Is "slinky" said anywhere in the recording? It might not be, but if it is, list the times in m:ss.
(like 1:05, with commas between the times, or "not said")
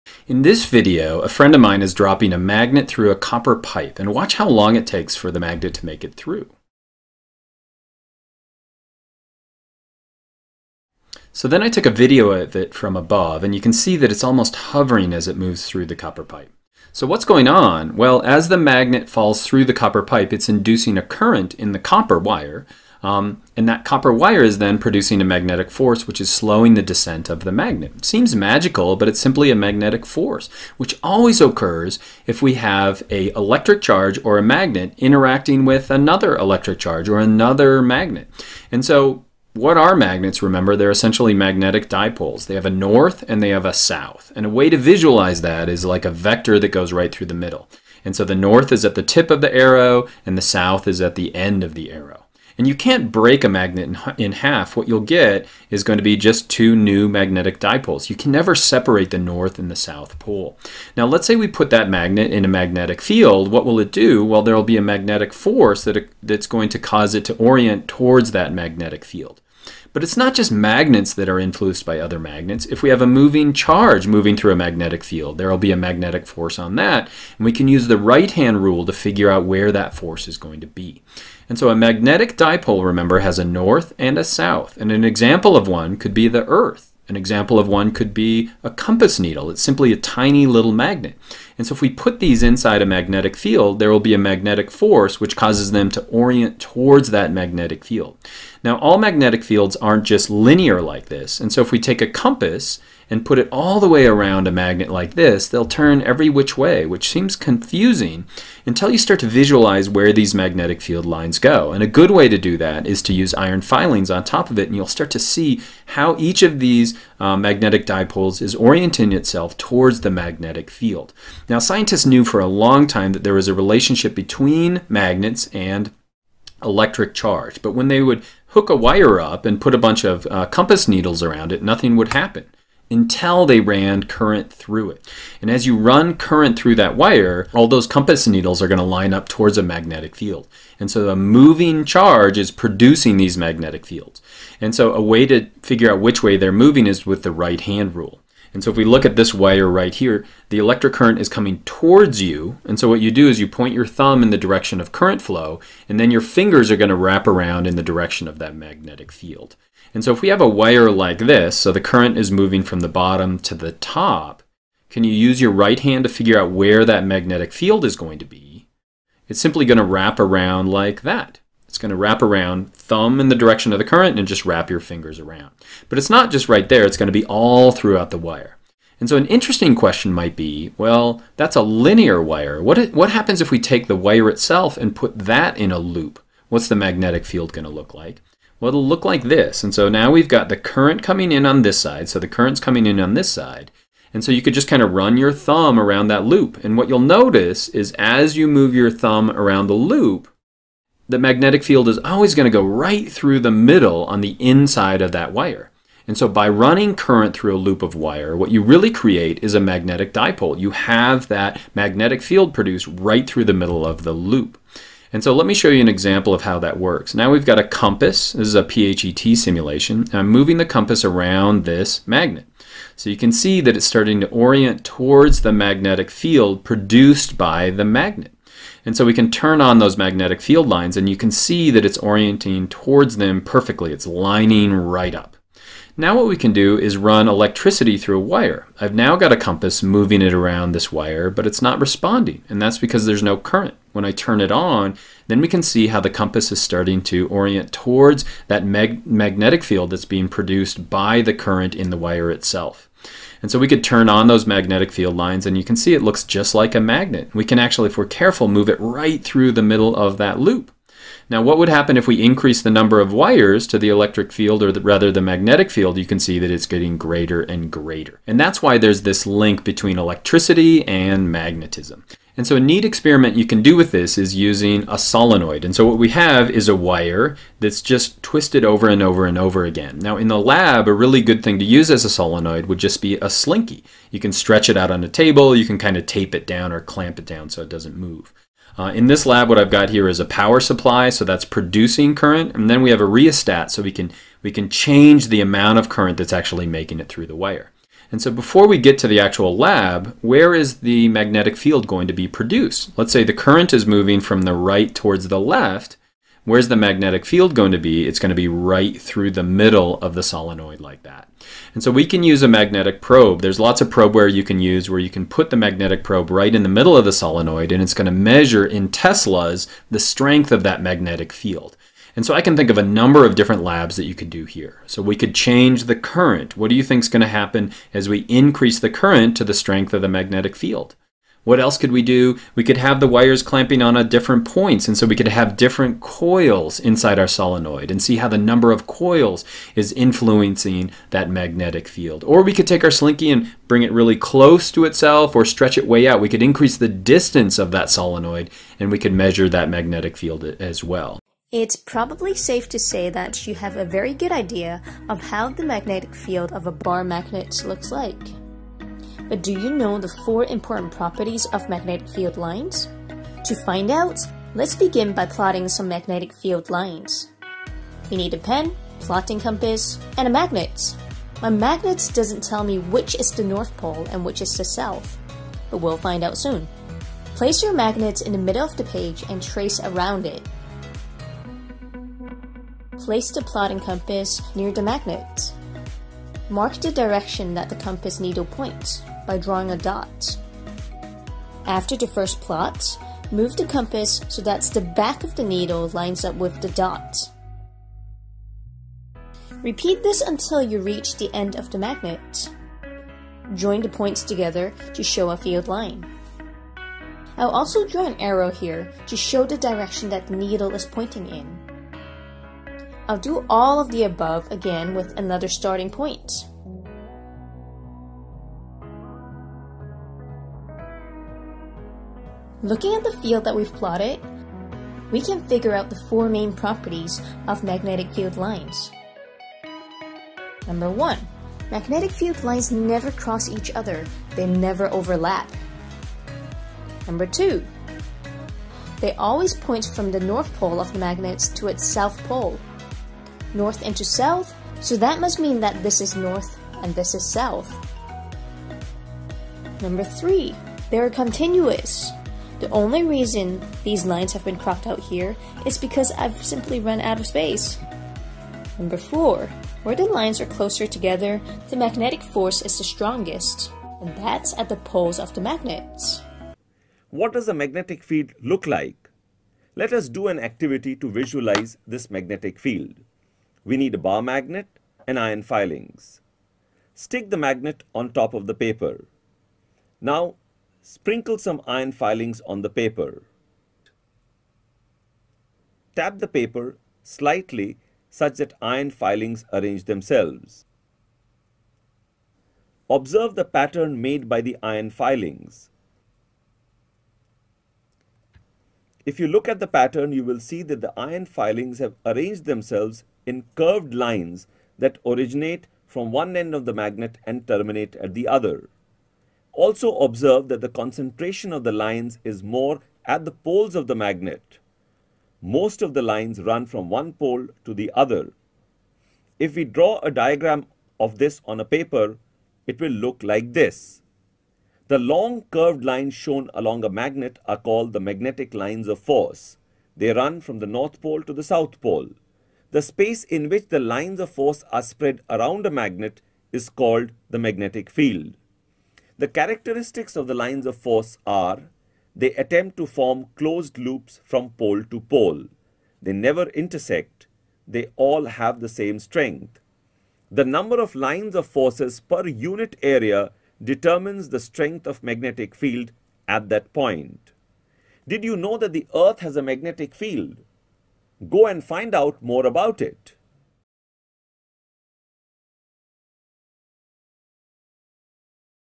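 4:43, 5:42.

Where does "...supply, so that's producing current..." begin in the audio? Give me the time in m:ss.
4:50.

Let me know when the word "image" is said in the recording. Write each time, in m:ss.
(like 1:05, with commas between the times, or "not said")
not said.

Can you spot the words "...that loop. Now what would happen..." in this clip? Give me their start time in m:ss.
4:20.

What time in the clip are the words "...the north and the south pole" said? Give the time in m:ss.
0:59.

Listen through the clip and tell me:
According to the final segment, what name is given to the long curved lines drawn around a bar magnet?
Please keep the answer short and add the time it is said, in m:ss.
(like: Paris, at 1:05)
magnetic lines of force, at 8:47.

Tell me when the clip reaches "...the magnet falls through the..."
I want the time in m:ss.
0:18.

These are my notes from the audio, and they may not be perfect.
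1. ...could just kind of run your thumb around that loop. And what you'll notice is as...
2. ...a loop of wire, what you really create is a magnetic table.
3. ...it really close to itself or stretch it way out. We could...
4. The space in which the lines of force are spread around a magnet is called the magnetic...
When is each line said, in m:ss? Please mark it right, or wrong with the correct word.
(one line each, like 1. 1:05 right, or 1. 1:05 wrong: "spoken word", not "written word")
1. 3:14 right
2. 3:27 wrong: "dipole", not "table"
3. 5:43 right
4. 8:52 right.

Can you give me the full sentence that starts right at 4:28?
And that's why there's this link between electricity and magnetism.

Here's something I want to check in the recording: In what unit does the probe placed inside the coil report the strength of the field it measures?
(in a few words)
Teslas.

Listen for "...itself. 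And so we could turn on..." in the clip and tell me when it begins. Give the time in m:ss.
4:12.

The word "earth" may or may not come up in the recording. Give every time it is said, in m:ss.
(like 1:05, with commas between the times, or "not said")
1:26, 9:18.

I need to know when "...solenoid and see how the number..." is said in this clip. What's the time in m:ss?
5:37.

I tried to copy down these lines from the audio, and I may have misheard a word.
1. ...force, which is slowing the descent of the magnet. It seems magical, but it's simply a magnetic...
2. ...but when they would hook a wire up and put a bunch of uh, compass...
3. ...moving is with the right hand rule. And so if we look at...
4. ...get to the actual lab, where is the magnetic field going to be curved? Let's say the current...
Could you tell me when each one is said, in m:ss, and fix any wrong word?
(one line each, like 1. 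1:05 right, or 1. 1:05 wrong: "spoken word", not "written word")
1. 0:25 right
2. 2:07 right
3. 2:26 right
4. 4:58 wrong: "produced", not "curved".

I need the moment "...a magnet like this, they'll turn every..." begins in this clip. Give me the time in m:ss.
1:44.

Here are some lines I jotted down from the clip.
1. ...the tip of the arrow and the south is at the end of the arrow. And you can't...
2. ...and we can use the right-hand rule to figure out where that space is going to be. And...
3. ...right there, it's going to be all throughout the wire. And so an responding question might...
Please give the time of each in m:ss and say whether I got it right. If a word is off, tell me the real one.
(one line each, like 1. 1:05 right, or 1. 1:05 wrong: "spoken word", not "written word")
1. 0:48 right
2. 1:17 wrong: "force", not "space"
3. 2:56 wrong: "interesting", not "responding".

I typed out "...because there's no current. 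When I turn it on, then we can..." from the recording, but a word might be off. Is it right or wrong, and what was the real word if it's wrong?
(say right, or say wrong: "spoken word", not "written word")
right.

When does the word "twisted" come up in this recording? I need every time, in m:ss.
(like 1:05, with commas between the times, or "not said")
4:38.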